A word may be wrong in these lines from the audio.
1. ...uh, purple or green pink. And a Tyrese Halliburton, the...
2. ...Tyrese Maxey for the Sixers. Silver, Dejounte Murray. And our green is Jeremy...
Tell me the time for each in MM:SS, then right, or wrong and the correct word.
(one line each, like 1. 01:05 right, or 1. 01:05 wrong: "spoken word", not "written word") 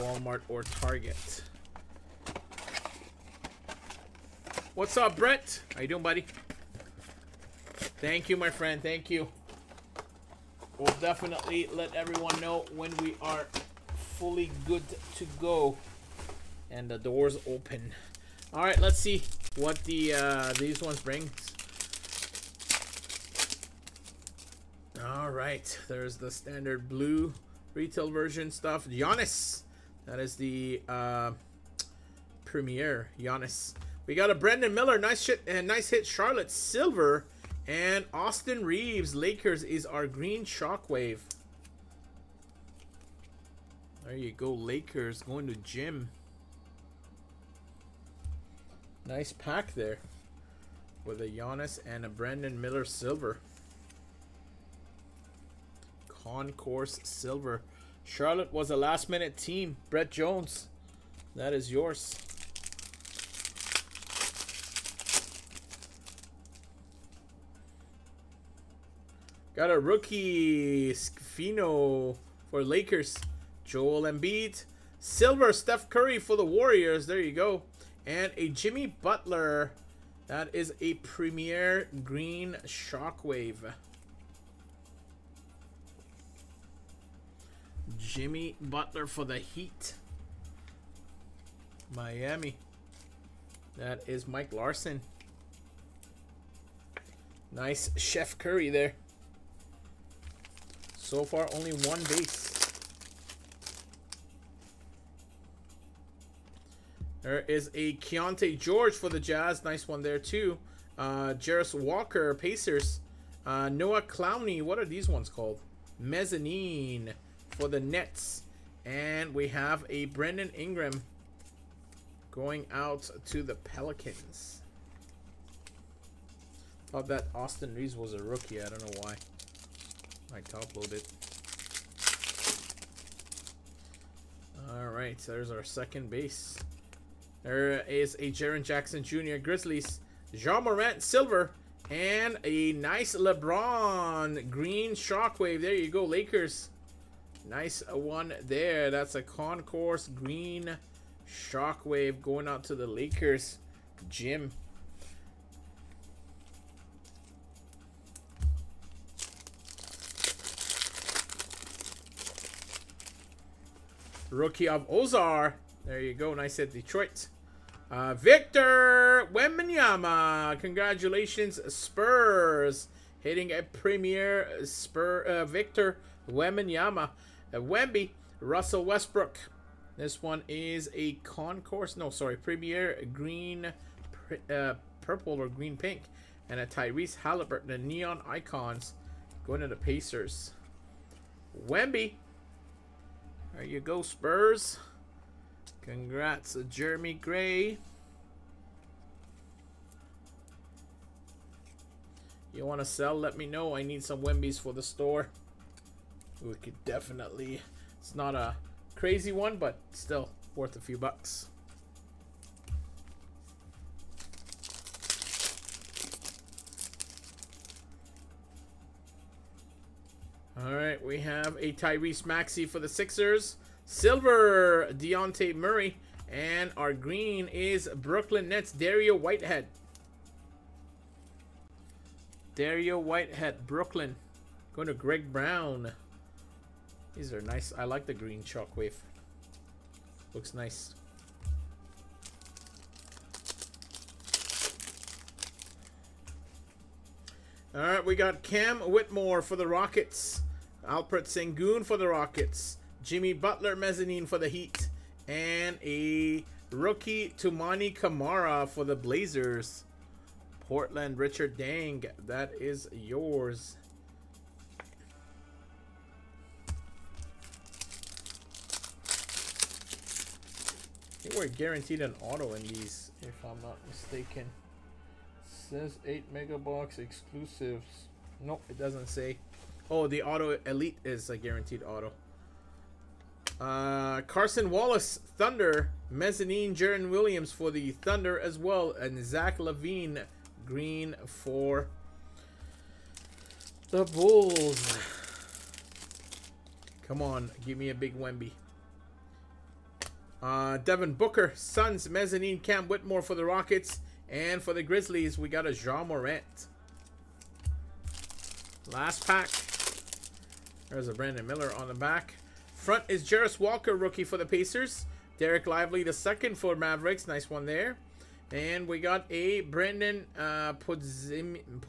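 1. 03:04 right
2. 03:41 wrong: "Brooklyn", not "Jeremy".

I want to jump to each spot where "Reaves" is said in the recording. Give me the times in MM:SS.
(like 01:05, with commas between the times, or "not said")
00:38, 02:07.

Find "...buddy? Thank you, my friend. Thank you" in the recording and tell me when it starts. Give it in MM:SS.
00:06.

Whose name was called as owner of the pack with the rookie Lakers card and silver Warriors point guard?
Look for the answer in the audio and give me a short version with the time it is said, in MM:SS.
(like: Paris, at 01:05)
Brett Jones, at 00:59.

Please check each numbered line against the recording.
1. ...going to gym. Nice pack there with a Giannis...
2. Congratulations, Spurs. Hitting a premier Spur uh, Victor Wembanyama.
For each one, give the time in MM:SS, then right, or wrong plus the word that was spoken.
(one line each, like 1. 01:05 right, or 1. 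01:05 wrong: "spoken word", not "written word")
1. 00:45 right
2. 02:50 right.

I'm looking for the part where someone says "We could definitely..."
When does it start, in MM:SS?
03:26.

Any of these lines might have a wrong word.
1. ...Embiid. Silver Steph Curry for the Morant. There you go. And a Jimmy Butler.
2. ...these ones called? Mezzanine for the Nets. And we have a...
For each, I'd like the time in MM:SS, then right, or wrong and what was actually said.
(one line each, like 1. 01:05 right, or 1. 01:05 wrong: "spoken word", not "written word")
1. 01:14 wrong: "Warriors", not "Morant"
2. 01:54 right.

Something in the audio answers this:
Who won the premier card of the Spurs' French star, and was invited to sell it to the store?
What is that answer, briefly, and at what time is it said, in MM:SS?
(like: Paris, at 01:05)
Jeremy Gray, at 03:16.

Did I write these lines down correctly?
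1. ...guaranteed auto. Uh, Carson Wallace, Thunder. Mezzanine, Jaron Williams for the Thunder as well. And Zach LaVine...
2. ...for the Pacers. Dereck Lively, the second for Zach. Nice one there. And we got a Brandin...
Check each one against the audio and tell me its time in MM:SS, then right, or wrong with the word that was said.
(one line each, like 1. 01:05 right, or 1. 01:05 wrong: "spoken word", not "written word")
1. 04:41 right
2. 05:14 wrong: "Mavericks", not "Zach".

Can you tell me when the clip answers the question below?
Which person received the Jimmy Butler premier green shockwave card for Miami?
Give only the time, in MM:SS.
01:34.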